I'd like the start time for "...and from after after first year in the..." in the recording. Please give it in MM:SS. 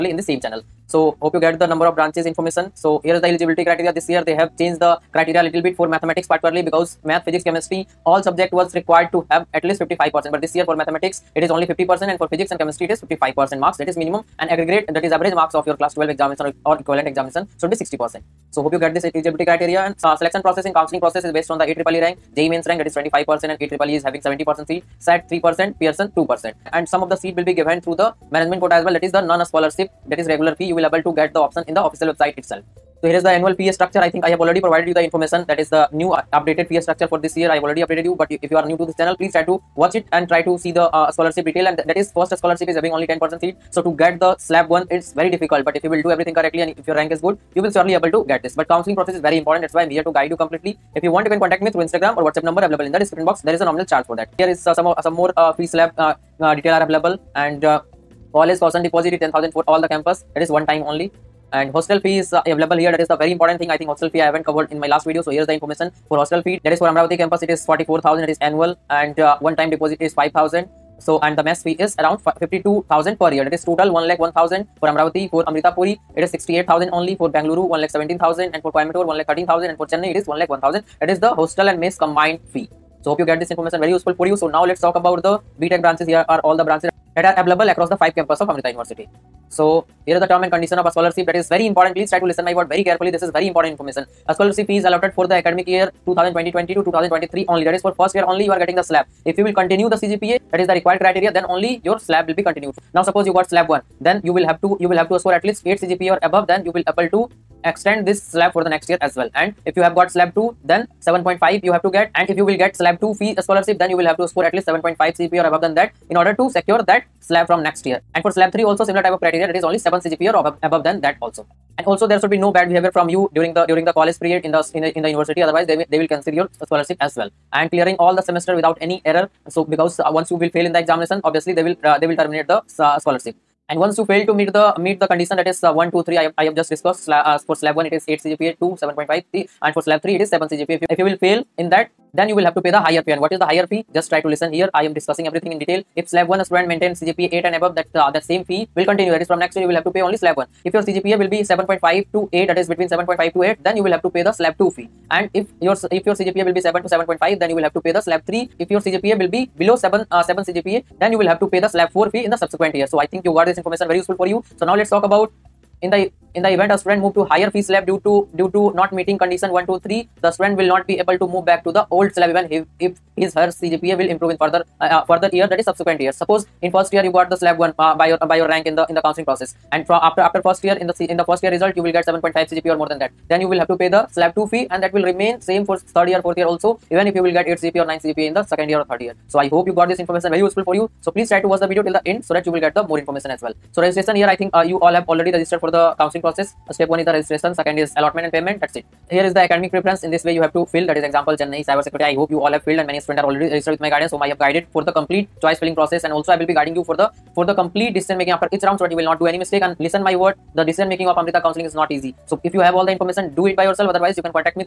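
02:59.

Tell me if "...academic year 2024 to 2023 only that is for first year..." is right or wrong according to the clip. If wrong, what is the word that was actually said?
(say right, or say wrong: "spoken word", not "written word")
wrong: "2020", not "2024".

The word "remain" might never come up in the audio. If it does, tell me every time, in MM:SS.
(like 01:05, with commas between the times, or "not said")
03:05.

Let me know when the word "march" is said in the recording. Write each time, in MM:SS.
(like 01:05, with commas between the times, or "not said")
not said.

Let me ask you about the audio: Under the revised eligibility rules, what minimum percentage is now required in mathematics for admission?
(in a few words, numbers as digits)
50%.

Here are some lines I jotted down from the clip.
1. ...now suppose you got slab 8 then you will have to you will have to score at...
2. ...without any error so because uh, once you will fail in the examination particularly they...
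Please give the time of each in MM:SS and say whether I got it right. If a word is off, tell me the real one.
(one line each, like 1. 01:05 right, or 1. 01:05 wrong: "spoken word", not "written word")
1. 01:42 wrong: "1", not "8"
2. 02:08 wrong: "obviously", not "particularly".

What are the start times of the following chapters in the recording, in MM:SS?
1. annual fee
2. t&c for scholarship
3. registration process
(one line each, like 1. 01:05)
1. 00:33
2. 01:31
3. 03:13.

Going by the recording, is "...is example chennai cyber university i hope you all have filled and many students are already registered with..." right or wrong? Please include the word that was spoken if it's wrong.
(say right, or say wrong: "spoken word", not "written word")
wrong: "security", not "university".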